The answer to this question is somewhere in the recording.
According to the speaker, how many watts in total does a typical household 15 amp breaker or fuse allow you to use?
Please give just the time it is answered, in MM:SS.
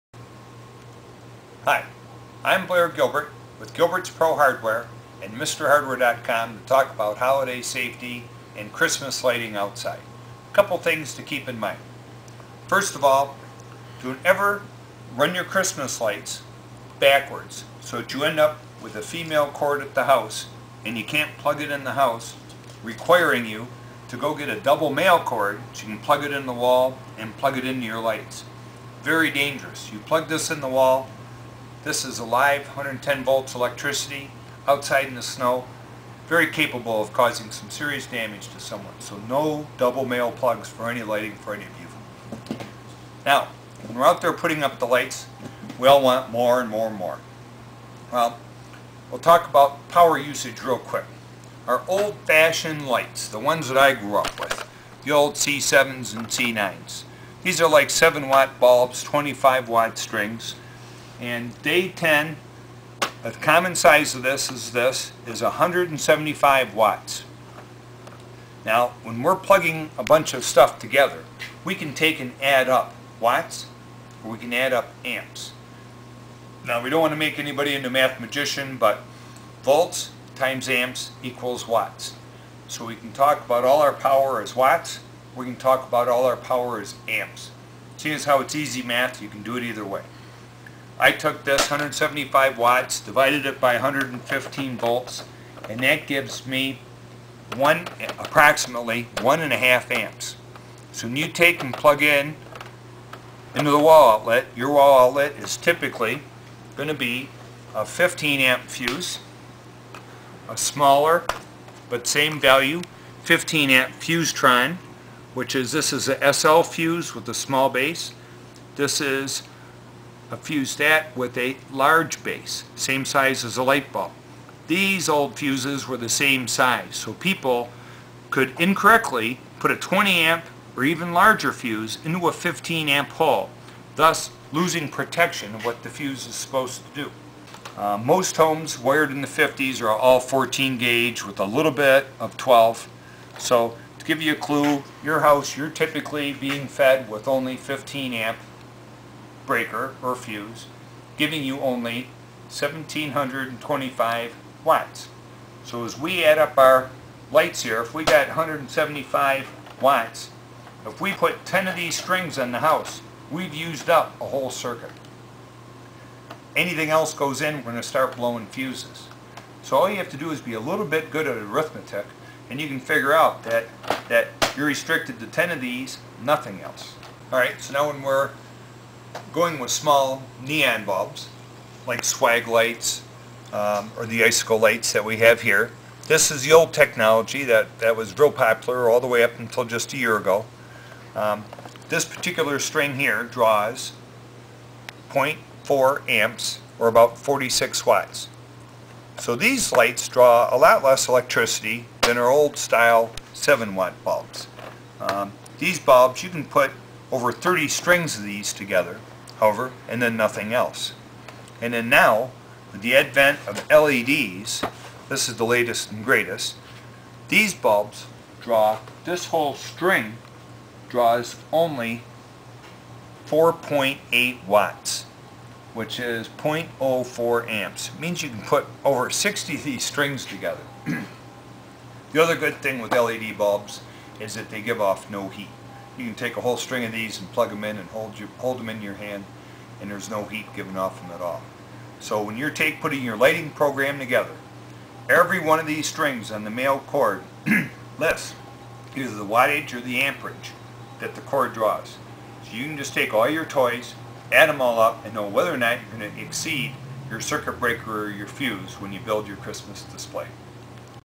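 02:32.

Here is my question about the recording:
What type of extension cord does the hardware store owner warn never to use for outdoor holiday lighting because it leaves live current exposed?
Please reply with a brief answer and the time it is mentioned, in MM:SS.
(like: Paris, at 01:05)
Double male cord, at 00:24.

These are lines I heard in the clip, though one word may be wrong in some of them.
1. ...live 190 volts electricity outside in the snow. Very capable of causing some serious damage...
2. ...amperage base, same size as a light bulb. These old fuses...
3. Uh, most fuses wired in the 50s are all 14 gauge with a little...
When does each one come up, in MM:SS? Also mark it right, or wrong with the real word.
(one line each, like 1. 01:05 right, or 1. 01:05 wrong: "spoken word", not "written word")
1. 00:32 wrong: "110", not "190"
2. 02:01 wrong: "large", not "amperage"
3. 02:17 wrong: "homes", not "fuses".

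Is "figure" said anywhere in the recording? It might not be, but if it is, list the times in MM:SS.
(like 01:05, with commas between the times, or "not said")
02:52.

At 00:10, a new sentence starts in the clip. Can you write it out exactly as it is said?
A couple things to keep in mind.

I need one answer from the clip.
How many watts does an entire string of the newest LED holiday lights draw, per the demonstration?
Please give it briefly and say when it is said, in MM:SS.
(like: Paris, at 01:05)
4.8 watts, at 03:43.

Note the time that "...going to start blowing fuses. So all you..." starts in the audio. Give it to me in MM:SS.
02:47.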